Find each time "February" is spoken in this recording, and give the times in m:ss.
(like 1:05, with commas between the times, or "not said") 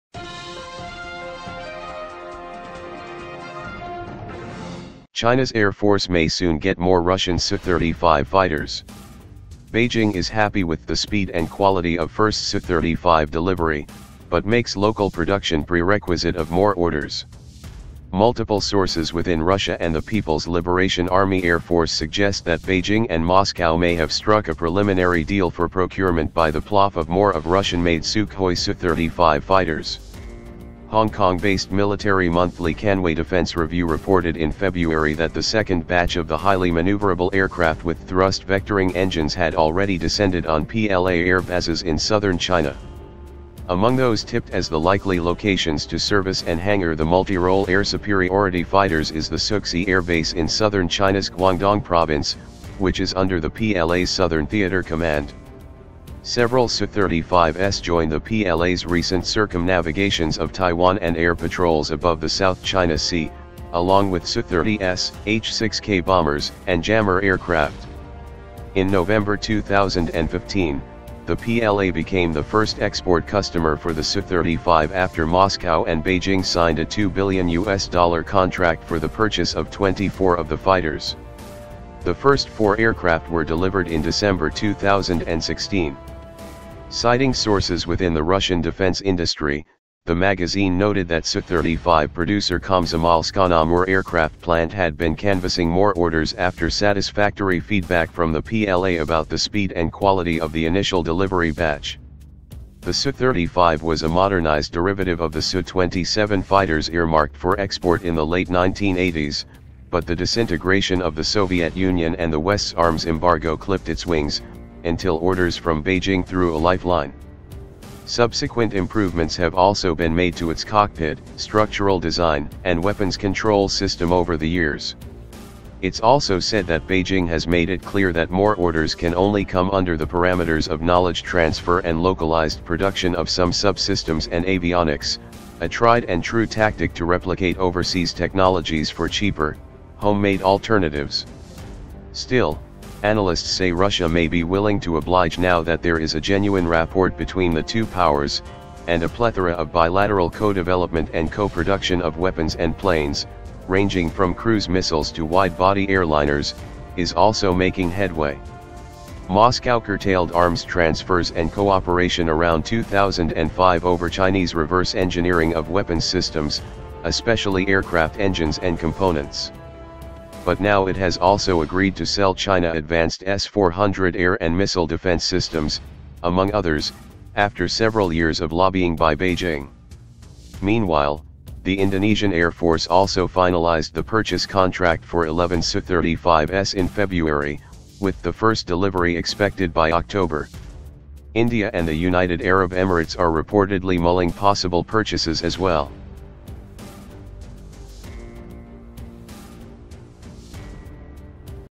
0:34, 3:06.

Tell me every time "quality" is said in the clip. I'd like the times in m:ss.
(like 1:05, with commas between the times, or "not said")
0:11, 1:39.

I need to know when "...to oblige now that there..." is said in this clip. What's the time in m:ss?
2:24.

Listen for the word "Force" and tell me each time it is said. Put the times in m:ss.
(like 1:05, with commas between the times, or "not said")
0:05, 0:21, 3:02.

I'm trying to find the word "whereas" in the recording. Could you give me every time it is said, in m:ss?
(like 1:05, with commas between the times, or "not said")
not said.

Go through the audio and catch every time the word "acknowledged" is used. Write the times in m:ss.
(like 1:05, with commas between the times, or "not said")
not said.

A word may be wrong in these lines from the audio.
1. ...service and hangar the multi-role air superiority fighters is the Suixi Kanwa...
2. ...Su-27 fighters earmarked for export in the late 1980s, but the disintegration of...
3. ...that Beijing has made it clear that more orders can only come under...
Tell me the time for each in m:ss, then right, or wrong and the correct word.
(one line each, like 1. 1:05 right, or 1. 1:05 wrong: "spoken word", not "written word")
1. 0:45 wrong: "Air", not "Kanwa"
2. 1:45 right
3. 2:06 right.